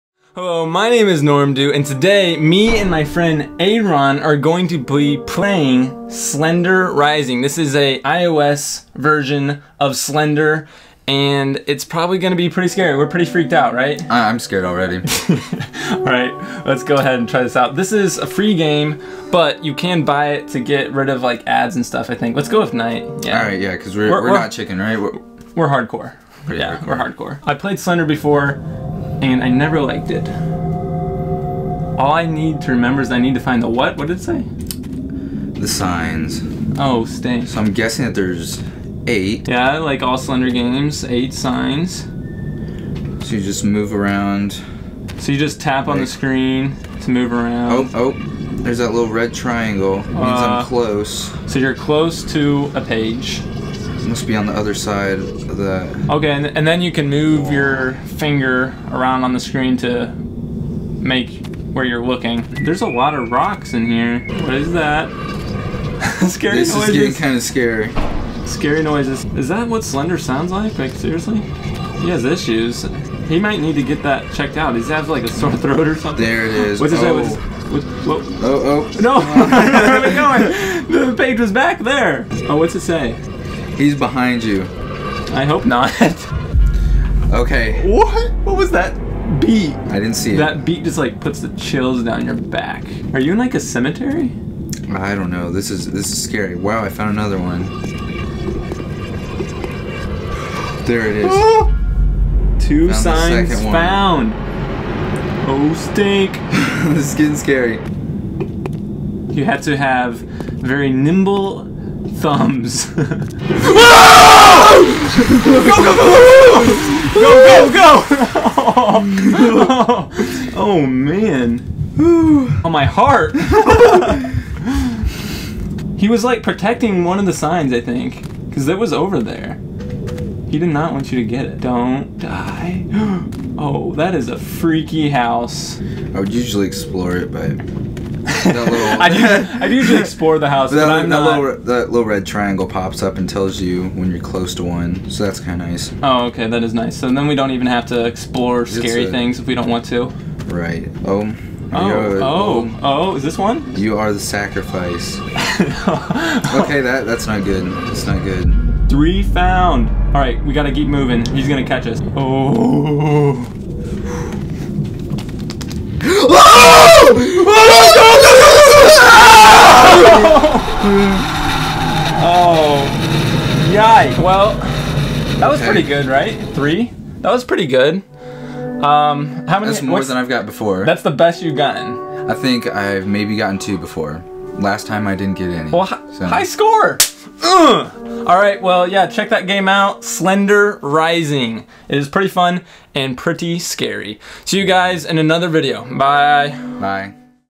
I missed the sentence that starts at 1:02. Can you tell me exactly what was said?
There's a lot of rocks in here.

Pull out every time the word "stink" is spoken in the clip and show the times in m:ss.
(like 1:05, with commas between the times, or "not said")
0:37, 1:45.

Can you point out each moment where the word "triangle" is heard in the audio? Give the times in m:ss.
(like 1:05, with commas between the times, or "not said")
0:49, 2:22.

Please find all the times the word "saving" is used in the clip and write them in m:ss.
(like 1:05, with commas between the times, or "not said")
not said.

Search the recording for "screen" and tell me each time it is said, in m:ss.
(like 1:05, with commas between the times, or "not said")
0:46, 0:59.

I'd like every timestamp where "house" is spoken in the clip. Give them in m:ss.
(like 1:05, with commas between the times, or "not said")
2:15, 2:20.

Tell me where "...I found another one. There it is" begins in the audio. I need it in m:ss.
1:36.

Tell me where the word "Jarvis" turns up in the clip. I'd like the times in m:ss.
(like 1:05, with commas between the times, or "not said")
not said.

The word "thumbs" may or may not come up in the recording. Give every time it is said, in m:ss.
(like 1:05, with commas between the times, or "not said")
1:52.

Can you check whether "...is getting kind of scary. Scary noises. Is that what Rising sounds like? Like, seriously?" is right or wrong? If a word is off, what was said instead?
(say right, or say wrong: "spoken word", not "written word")
wrong: "Slender", not "Rising".